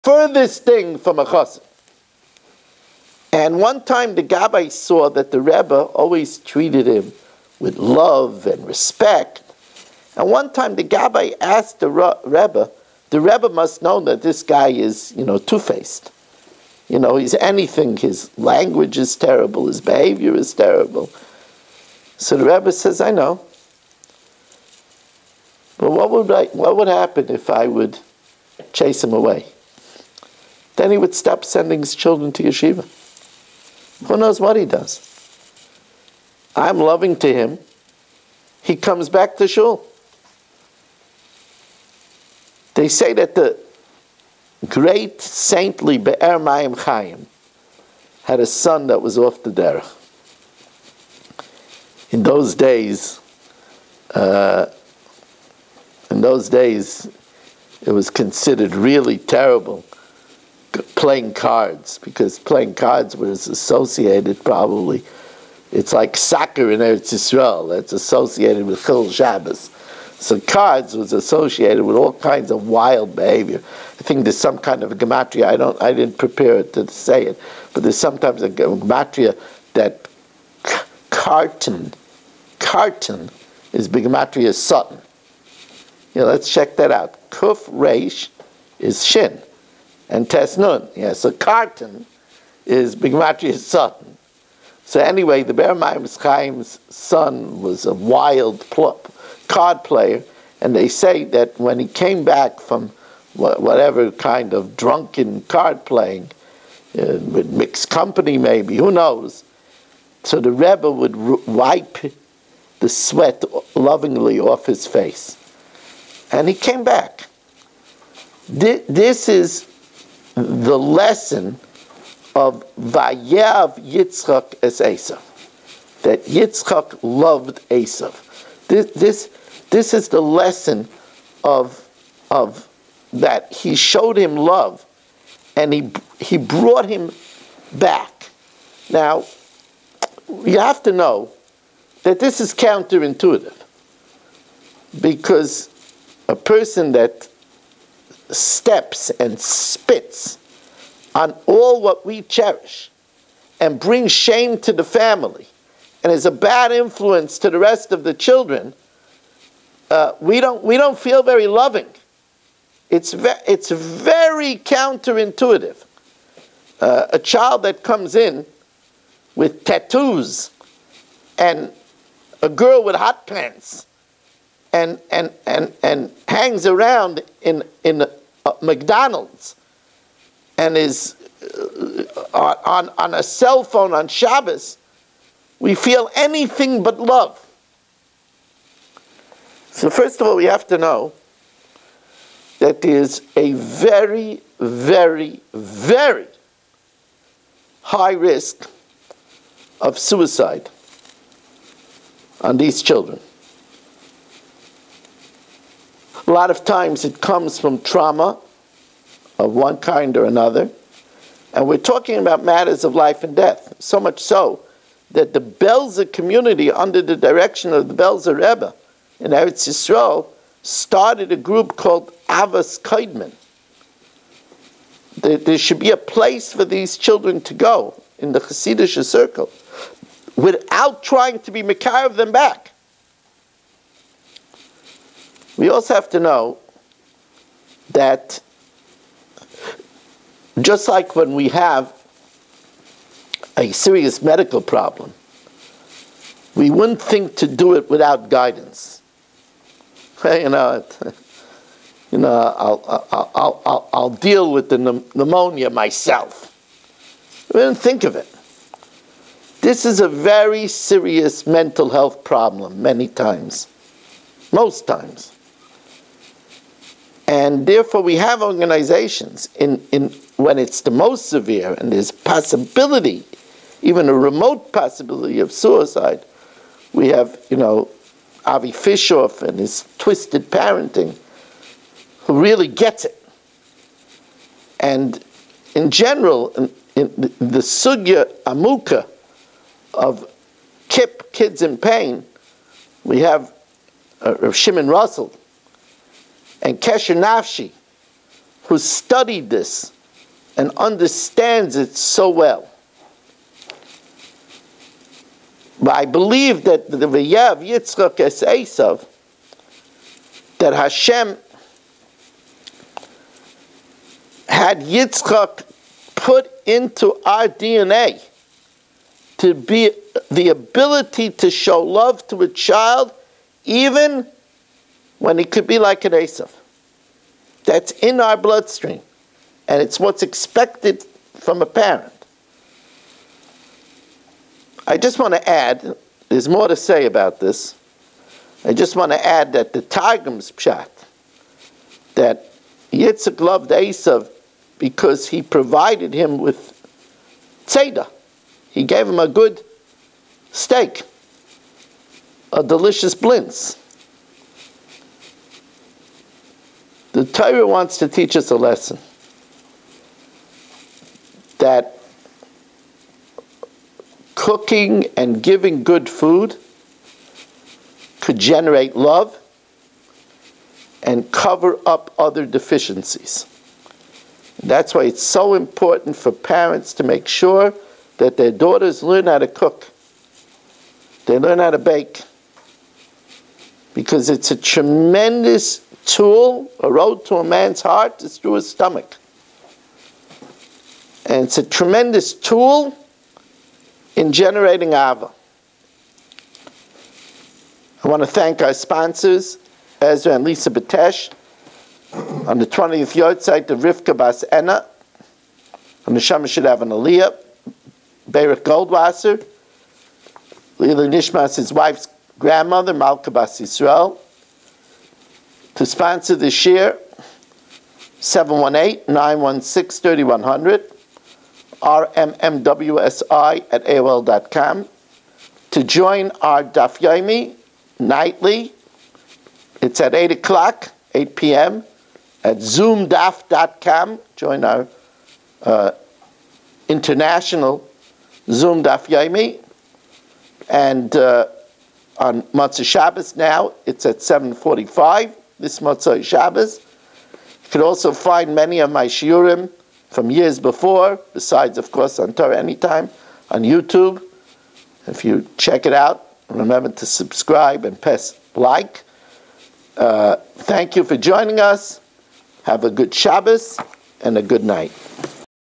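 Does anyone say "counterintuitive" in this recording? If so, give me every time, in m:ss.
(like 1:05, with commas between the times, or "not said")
2:22, 2:44.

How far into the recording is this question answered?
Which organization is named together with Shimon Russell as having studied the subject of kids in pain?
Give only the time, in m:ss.
4:56.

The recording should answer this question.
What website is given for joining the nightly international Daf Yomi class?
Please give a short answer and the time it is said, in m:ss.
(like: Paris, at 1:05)
zoomdaf.com, at 7:12.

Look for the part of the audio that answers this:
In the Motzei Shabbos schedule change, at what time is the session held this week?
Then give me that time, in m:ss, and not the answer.
7:24.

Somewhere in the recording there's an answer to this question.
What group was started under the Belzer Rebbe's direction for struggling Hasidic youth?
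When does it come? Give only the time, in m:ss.
3:42.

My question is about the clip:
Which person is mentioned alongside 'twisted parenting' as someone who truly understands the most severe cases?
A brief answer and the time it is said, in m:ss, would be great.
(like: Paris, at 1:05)
Avi Fishoff, at 4:38.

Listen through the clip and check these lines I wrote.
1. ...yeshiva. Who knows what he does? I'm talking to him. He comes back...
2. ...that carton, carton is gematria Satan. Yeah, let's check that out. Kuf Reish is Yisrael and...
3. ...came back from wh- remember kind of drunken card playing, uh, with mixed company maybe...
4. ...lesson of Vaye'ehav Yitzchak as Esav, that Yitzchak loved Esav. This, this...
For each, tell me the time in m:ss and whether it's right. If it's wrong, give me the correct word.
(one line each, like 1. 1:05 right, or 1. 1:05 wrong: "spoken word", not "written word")
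1. 0:32 wrong: "loving", not "talking"
2. 1:19 wrong: "Shin", not "Yisrael"
3. 1:41 wrong: "whatever", not "remember"
4. 2:00 right.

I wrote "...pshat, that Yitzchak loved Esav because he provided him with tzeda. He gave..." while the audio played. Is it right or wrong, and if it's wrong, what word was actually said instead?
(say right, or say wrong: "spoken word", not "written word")
right.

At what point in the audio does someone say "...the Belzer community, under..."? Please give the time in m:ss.
3:35.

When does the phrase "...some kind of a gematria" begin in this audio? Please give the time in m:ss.
1:14.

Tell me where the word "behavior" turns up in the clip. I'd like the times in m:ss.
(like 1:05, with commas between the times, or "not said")
0:19, 1:13.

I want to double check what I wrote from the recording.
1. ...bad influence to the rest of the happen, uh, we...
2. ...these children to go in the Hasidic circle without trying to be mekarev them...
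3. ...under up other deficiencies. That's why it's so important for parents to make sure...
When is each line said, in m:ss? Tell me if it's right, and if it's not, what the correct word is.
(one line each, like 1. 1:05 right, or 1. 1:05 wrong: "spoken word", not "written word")
1. 2:36 wrong: "children", not "happen"
2. 3:46 right
3. 6:11 wrong: "cover", not "under".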